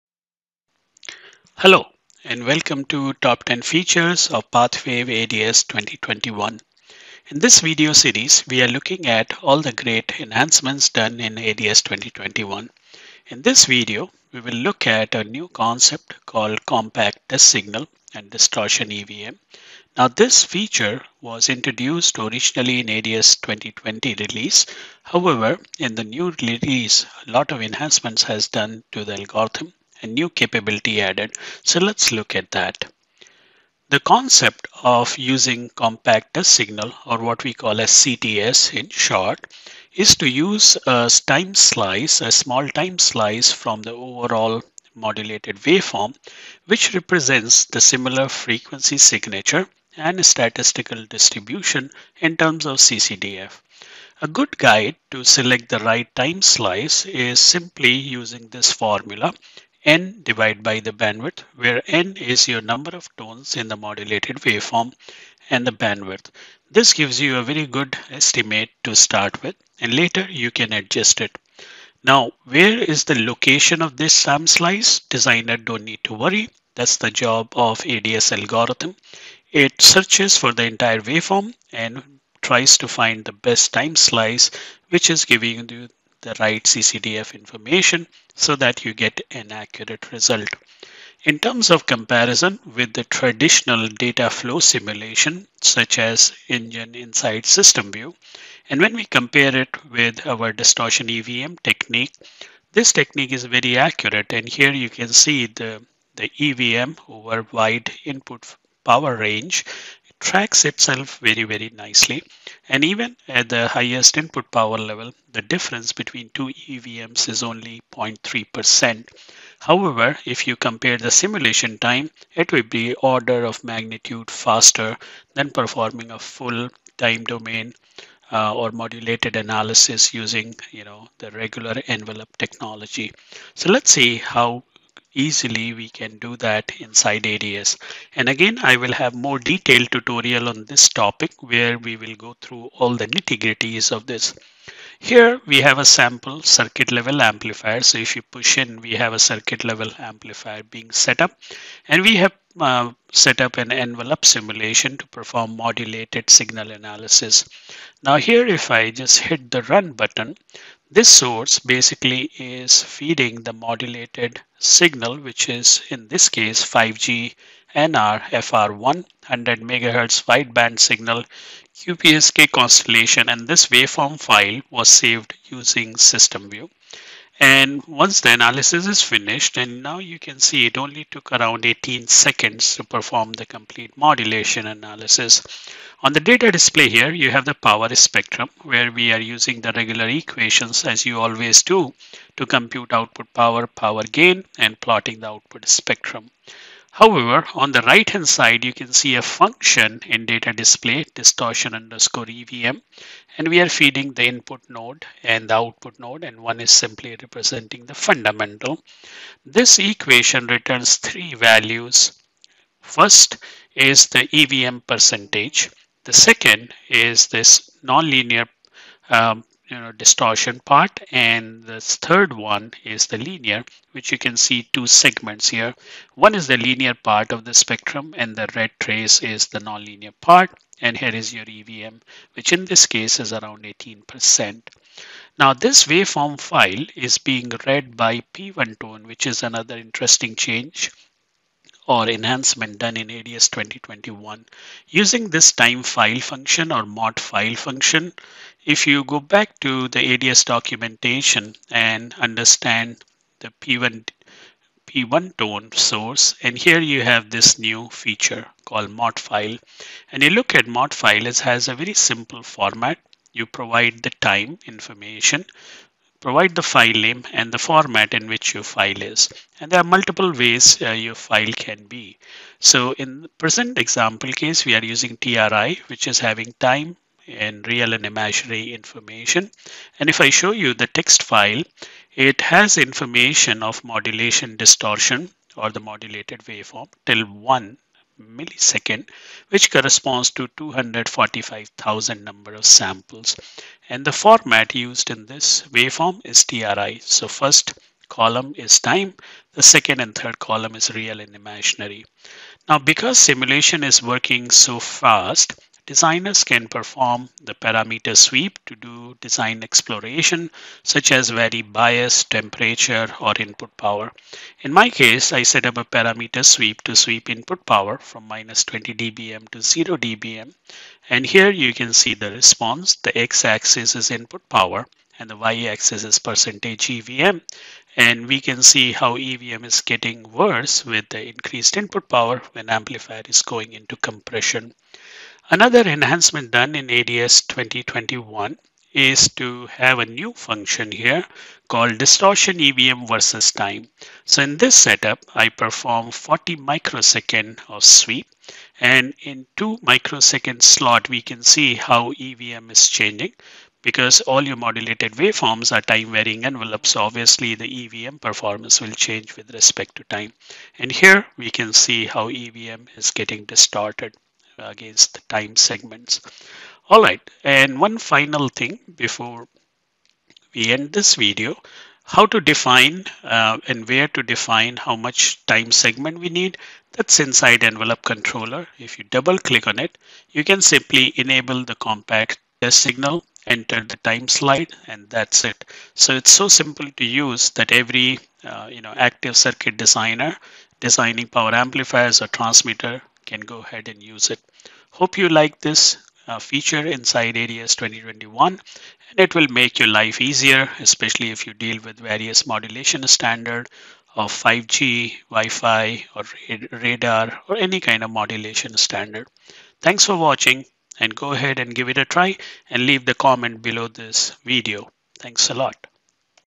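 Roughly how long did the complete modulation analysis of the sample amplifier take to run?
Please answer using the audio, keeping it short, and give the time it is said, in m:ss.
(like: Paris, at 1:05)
18 seconds, at 3:01.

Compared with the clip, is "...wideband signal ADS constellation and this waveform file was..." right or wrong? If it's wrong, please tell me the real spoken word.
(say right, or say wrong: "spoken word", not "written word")
wrong: "QPSK", not "ADS".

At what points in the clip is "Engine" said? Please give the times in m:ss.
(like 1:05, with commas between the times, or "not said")
1:36.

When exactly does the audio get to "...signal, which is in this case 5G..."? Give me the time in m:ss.
2:44.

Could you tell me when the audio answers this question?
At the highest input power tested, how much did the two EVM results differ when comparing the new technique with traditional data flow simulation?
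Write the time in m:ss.
1:57.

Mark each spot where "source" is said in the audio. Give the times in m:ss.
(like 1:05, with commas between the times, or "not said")
2:41, 4:15.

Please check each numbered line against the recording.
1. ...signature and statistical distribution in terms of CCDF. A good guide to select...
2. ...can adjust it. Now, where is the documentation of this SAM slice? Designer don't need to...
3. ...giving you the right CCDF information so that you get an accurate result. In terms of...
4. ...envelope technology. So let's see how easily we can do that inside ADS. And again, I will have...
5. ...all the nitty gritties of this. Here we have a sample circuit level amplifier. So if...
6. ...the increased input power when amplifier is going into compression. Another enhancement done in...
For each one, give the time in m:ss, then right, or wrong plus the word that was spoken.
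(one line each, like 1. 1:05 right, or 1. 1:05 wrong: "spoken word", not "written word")
1. 0:48 right
2. 1:10 wrong: "location", not "documentation"
3. 1:25 right
4. 2:11 right
5. 2:22 right
6. 5:31 right.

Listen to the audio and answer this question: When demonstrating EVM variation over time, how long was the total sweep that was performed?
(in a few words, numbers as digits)
40 microseconds.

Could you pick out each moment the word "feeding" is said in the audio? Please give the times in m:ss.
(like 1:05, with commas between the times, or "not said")
2:42, 3:23.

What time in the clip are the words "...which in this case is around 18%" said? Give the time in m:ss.
3:52.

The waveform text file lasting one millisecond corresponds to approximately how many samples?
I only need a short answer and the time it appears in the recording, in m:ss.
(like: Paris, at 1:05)
245,000, at 4:50.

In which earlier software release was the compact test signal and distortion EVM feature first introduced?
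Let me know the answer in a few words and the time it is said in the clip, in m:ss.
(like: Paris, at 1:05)
ADS 2020, at 0:22.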